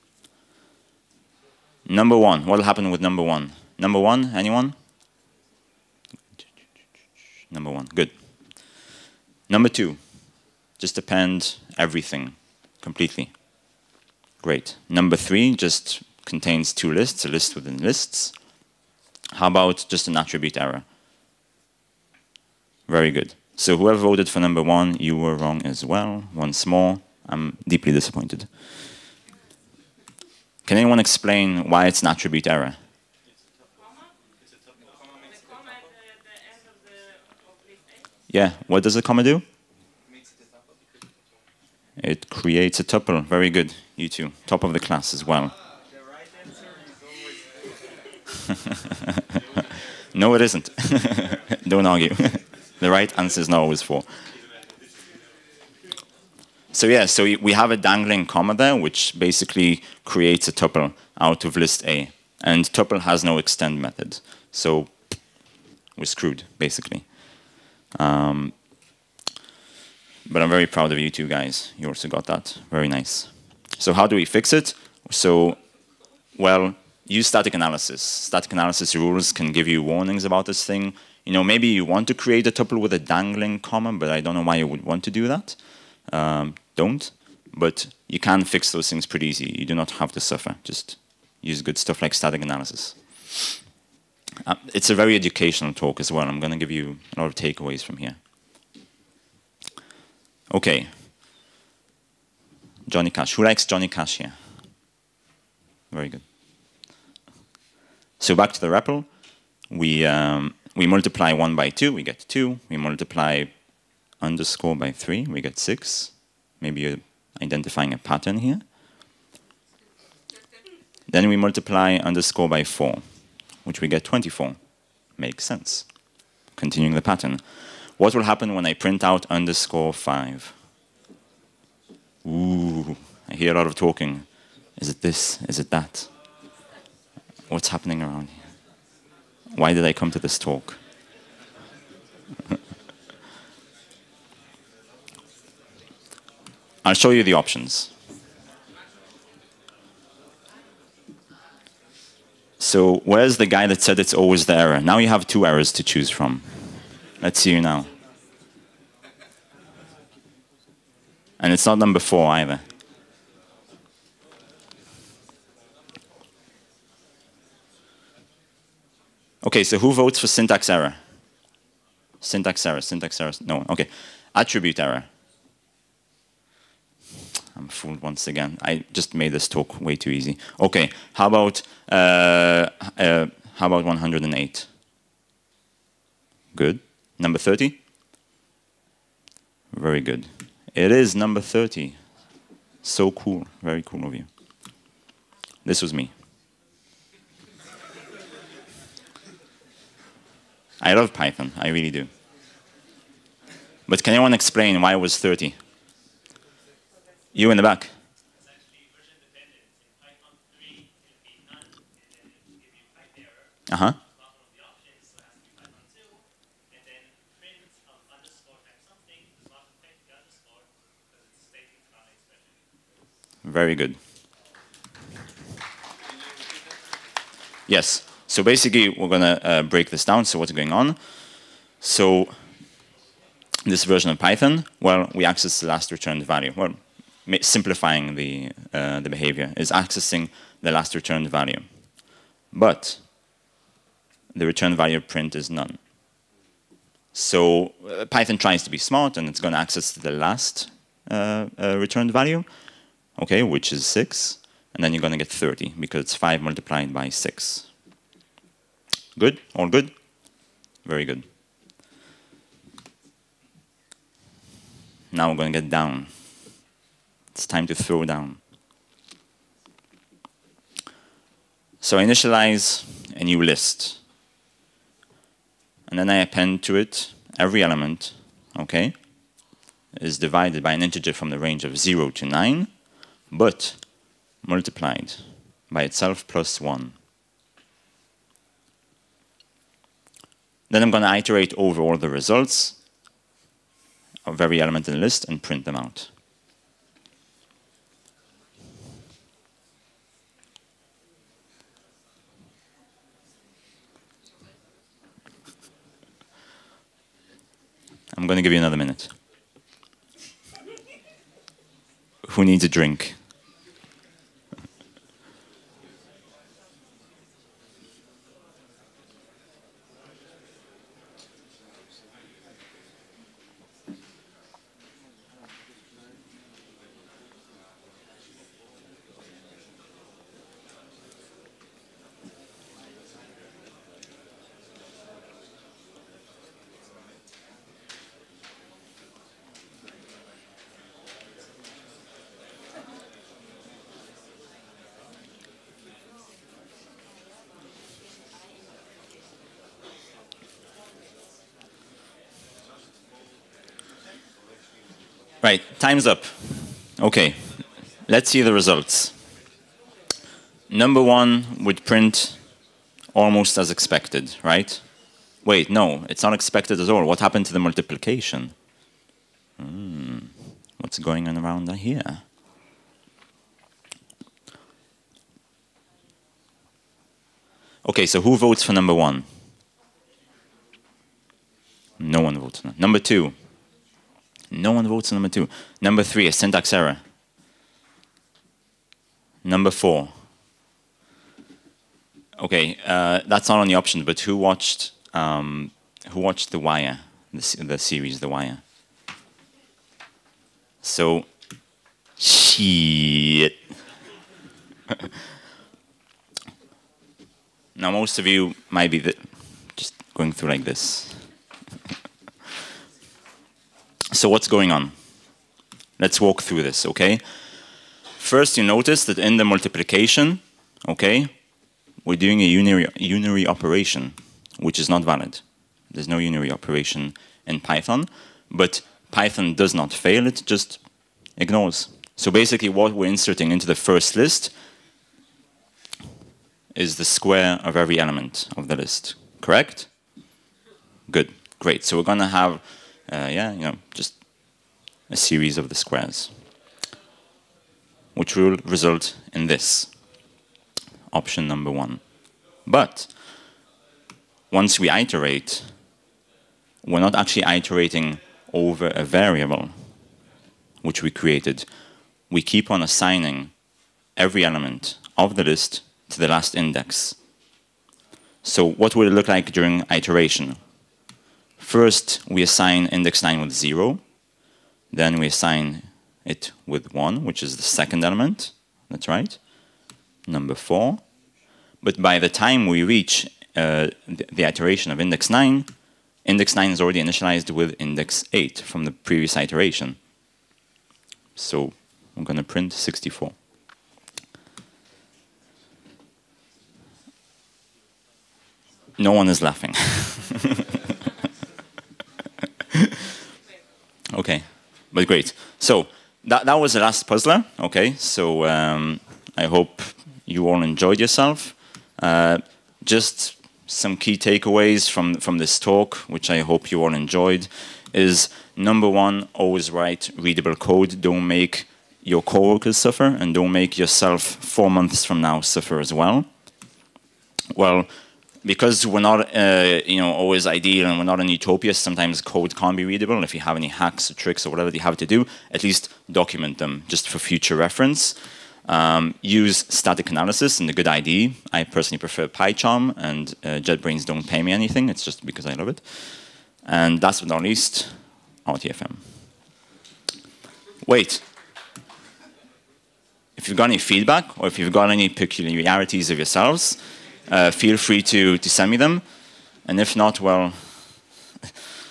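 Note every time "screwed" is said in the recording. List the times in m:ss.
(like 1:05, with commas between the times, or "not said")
1:06.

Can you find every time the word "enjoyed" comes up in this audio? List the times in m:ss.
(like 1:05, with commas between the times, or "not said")
8:30, 8:36.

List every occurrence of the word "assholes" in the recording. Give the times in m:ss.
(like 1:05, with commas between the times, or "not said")
not said.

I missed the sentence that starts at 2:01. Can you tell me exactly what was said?
Then we multiply underscore by 4, which we get 24.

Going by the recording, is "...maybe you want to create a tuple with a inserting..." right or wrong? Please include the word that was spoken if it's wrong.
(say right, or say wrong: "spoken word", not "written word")
wrong: "dangling", not "inserting".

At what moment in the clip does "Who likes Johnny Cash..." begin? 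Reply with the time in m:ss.
1:43.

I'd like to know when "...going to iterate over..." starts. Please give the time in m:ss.
4:50.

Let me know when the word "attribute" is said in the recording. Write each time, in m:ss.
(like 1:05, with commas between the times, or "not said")
0:20, 0:32, 2:54.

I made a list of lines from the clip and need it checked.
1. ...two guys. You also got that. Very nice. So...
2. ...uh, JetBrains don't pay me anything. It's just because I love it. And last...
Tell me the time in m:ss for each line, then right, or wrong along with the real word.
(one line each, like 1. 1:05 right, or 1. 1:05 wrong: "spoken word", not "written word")
1. 1:11 right
2. 9:03 right.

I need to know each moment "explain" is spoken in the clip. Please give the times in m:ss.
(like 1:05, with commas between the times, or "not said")
0:30, 3:24.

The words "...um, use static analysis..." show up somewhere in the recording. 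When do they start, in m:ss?
8:58.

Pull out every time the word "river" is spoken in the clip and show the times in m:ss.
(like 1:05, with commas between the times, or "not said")
not said.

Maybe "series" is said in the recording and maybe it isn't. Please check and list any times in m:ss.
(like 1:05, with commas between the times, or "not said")
6:37, 7:25.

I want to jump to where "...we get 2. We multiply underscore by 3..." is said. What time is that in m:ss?
1:51.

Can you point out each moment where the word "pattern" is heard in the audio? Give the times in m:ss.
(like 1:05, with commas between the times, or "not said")
1:57, 2:07.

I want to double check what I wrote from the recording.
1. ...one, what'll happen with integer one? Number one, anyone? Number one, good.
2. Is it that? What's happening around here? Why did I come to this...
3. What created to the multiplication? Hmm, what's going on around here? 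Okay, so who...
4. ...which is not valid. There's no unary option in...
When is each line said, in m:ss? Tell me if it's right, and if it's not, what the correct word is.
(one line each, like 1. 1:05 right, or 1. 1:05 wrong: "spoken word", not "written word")
1. 0:02 wrong: "number", not "integer"
2. 2:15 right
3. 6:07 wrong: "happened", not "created"
4. 7:04 wrong: "operation", not "option".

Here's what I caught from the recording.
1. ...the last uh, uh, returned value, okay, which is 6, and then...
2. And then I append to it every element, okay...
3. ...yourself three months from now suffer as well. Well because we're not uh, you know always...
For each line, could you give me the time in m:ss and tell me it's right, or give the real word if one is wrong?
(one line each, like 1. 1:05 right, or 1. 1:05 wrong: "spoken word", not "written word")
1. 4:09 right
2. 4:35 right
3. 8:43 wrong: "four", not "three".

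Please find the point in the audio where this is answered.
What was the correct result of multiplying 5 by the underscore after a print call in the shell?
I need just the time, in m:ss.
3:10.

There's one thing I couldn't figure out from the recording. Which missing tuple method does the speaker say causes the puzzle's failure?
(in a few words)
extend.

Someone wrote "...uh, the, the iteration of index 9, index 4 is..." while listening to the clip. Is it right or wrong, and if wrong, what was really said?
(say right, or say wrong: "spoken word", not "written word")
wrong: "9", not "4".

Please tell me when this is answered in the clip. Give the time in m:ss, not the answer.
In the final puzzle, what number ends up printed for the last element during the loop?
8:12.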